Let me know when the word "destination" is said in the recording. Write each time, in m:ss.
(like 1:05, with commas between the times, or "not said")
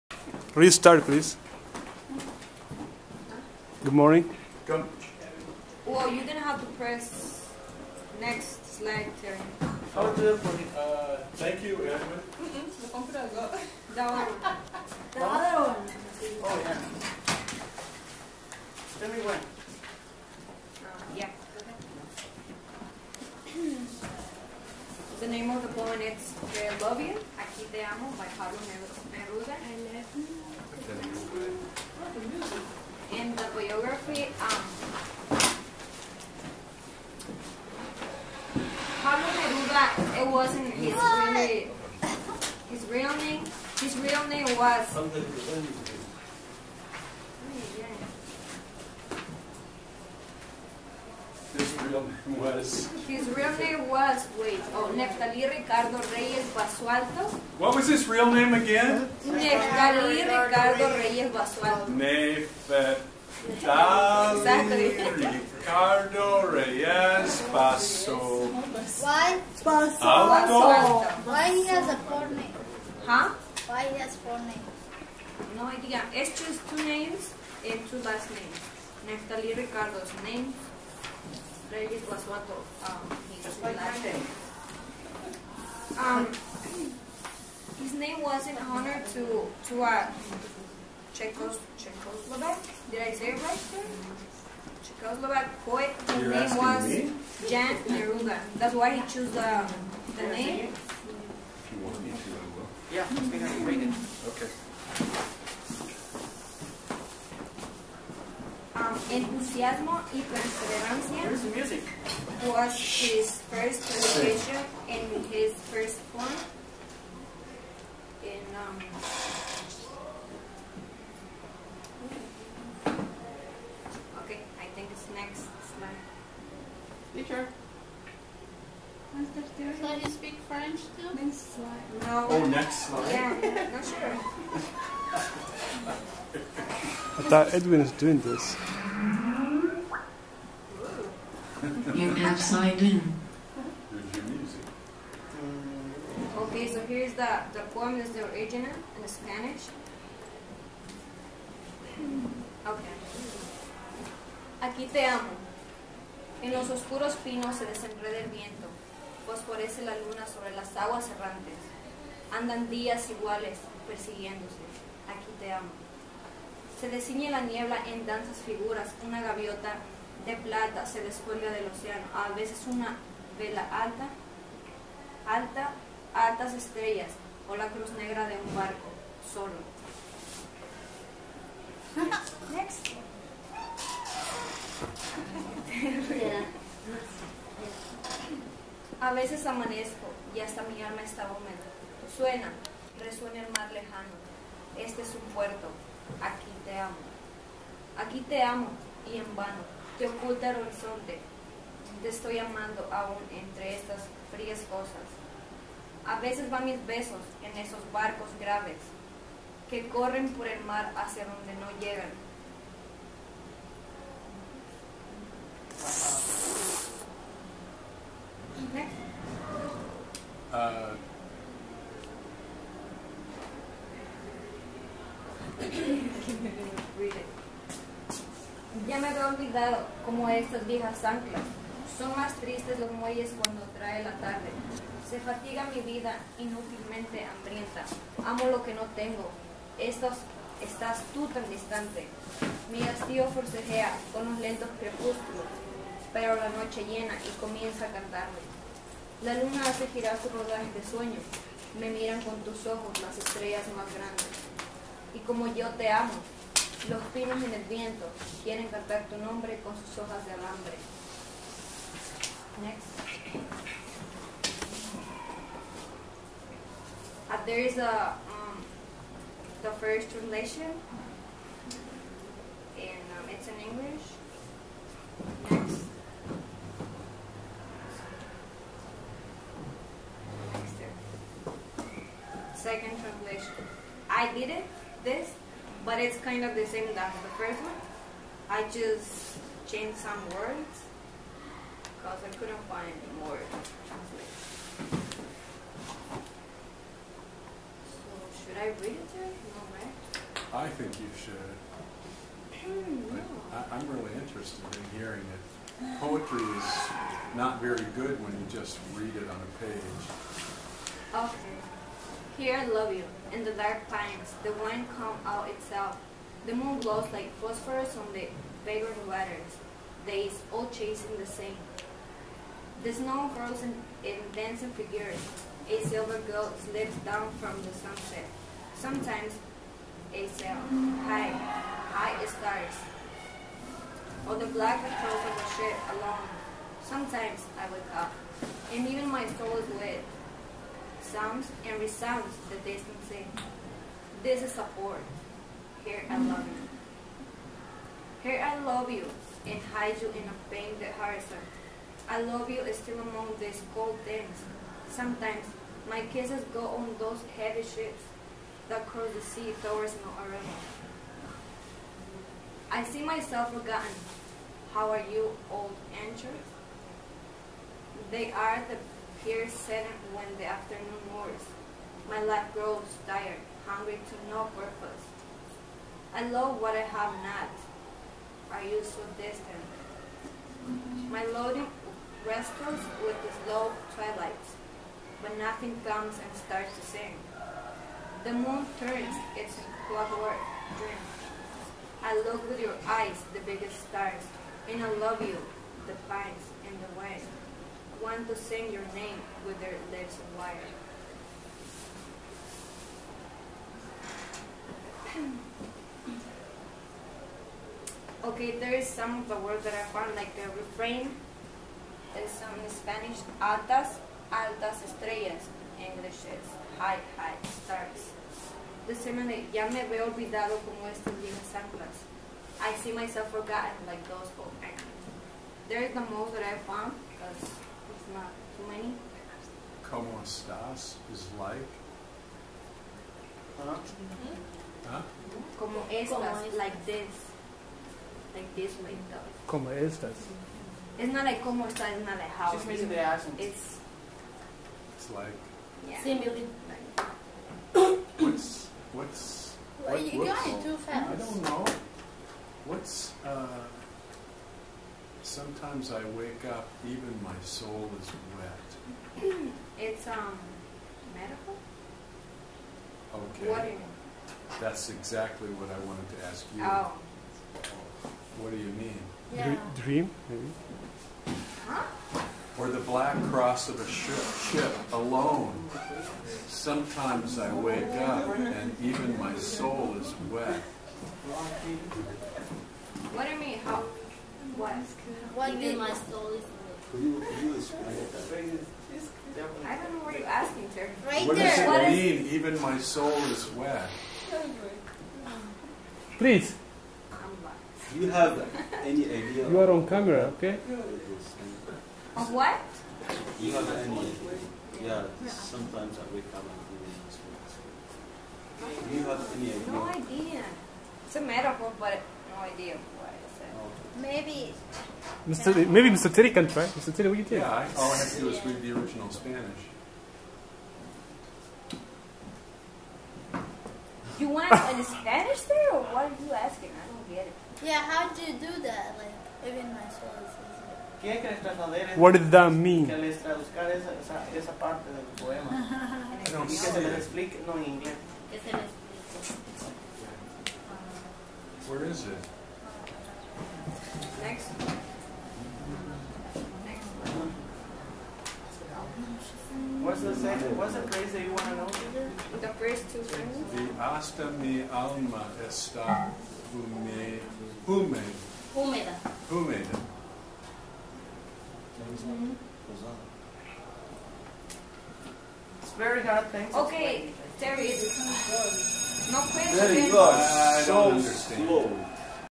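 not said.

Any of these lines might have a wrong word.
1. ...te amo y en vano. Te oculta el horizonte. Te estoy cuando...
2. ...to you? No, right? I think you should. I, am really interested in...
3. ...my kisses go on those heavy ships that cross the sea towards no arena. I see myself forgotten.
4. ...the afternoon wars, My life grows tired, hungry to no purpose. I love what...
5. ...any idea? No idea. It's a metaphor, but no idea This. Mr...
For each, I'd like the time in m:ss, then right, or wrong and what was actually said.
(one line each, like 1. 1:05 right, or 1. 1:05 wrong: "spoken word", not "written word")
1. 3:18 wrong: "amando", not "cuando"
2. 4:59 right
3. 5:55 right
4. 6:10 right
5. 8:29 wrong: "Maybe", not "This".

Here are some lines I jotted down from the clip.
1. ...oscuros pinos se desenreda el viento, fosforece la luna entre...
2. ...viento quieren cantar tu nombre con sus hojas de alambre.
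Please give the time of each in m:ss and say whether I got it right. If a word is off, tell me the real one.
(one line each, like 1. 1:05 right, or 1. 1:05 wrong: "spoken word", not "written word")
1. 2:36 wrong: "sobre", not "entre"
2. 4:17 right.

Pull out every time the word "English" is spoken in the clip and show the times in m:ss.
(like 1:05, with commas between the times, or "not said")
4:33, 6:55.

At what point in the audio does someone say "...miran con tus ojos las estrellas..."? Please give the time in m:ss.
4:11.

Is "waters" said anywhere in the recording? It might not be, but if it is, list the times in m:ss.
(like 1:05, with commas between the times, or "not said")
5:19, 7:43.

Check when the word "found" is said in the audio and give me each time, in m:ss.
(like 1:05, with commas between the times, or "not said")
6:49, 7:06.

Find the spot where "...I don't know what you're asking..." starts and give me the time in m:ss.
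8:09.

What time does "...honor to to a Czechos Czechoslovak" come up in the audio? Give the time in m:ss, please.
1:28.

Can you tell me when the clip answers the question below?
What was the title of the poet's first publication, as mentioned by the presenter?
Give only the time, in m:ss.
1:49.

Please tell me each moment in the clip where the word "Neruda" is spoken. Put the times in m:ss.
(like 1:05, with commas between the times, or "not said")
0:28, 0:39, 1:37.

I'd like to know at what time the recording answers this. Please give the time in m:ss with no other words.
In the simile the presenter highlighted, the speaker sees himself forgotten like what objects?
7:04.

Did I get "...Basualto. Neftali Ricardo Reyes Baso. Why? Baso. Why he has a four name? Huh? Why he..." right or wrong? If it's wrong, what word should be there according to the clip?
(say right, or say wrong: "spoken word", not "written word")
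right.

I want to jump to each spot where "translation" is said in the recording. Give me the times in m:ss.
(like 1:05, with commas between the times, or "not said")
4:30, 4:42.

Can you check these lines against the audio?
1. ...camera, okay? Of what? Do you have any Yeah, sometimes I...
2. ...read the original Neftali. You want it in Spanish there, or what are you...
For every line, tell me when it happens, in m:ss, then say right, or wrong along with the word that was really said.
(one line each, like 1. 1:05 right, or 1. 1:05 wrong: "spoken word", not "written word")
1. 8:19 right
2. 8:38 wrong: "Spanish", not "Neftali".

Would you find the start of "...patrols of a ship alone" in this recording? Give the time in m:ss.
5:34.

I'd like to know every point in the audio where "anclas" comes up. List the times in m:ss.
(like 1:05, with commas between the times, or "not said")
3:51, 7:01.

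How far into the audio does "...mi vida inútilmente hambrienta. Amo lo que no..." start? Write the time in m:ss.
3:55.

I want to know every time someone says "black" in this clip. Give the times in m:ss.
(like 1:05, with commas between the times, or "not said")
5:34, 7:52.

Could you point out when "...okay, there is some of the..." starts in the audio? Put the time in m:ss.
6:48.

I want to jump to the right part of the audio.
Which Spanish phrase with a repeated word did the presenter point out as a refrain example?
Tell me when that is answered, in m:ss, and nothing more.
6:53.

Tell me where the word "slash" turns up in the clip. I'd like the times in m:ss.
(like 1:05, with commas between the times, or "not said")
not said.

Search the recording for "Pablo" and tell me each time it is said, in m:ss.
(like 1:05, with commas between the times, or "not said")
0:28, 0:39.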